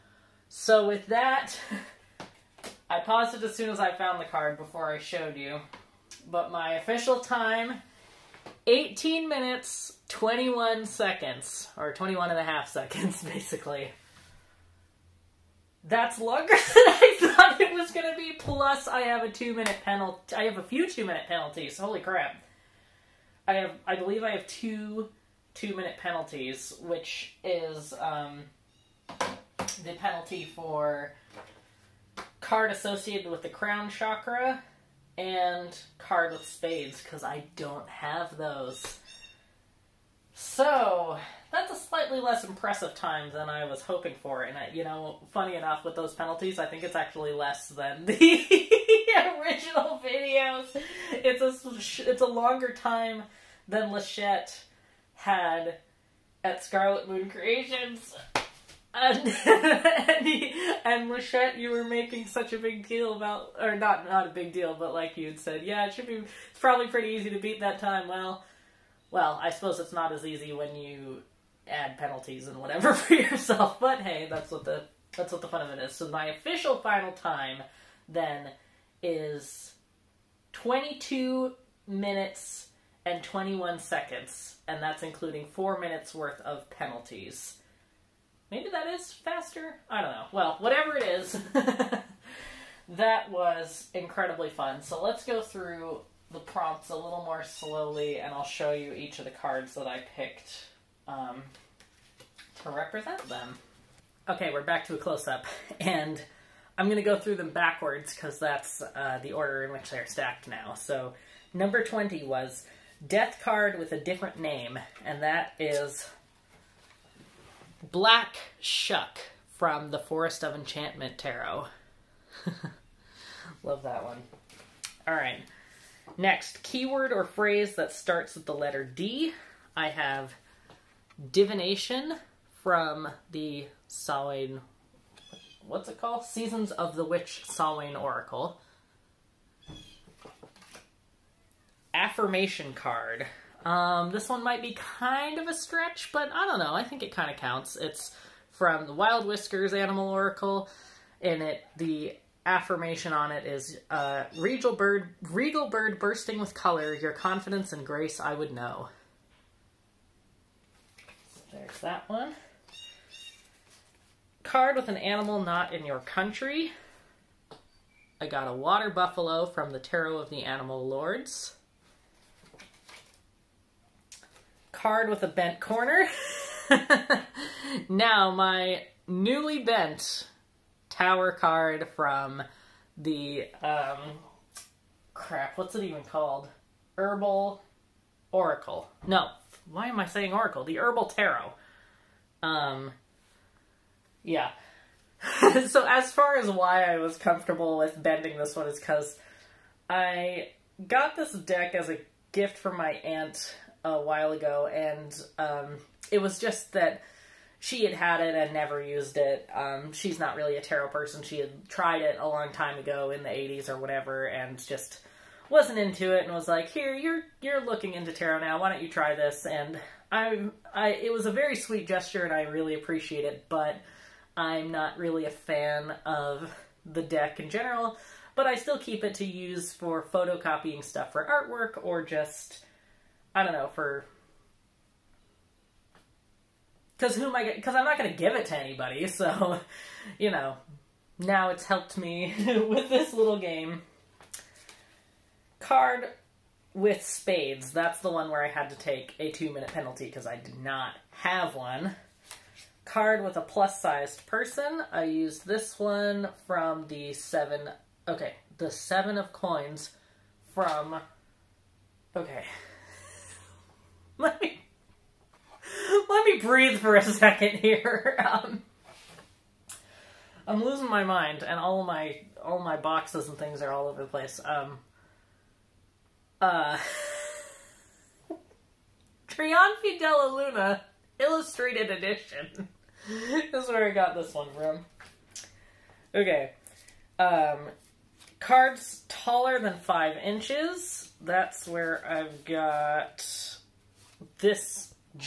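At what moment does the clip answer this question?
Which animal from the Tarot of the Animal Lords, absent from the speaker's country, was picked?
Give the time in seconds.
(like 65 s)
168 s.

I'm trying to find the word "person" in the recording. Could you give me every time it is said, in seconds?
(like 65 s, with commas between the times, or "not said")
210 s, 254 s.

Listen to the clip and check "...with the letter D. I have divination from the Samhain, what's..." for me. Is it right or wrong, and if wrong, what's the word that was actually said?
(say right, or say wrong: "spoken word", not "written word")
right.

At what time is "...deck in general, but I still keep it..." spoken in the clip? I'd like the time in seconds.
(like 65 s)
227 s.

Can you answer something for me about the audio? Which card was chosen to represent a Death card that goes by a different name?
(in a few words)
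Black Shuck.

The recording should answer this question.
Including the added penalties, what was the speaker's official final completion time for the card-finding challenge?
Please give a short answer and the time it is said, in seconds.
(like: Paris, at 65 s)
22 minutes 21 seconds, at 80 s.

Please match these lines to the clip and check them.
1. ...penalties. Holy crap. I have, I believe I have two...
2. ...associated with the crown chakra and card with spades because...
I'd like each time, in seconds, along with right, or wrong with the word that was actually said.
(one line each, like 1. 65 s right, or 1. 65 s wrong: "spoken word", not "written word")
1. 21 s right
2. 32 s right.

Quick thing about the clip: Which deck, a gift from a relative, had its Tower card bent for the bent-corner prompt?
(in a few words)
The Herbal Tarot.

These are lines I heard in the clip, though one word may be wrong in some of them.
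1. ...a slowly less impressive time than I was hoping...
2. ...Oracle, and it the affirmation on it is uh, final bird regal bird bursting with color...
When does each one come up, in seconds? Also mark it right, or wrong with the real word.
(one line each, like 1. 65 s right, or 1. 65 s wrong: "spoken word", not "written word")
1. 41 s wrong: "slightly", not "slowly"
2. 150 s wrong: "regal", not "final".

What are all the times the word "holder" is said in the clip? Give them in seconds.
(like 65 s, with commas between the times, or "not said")
not said.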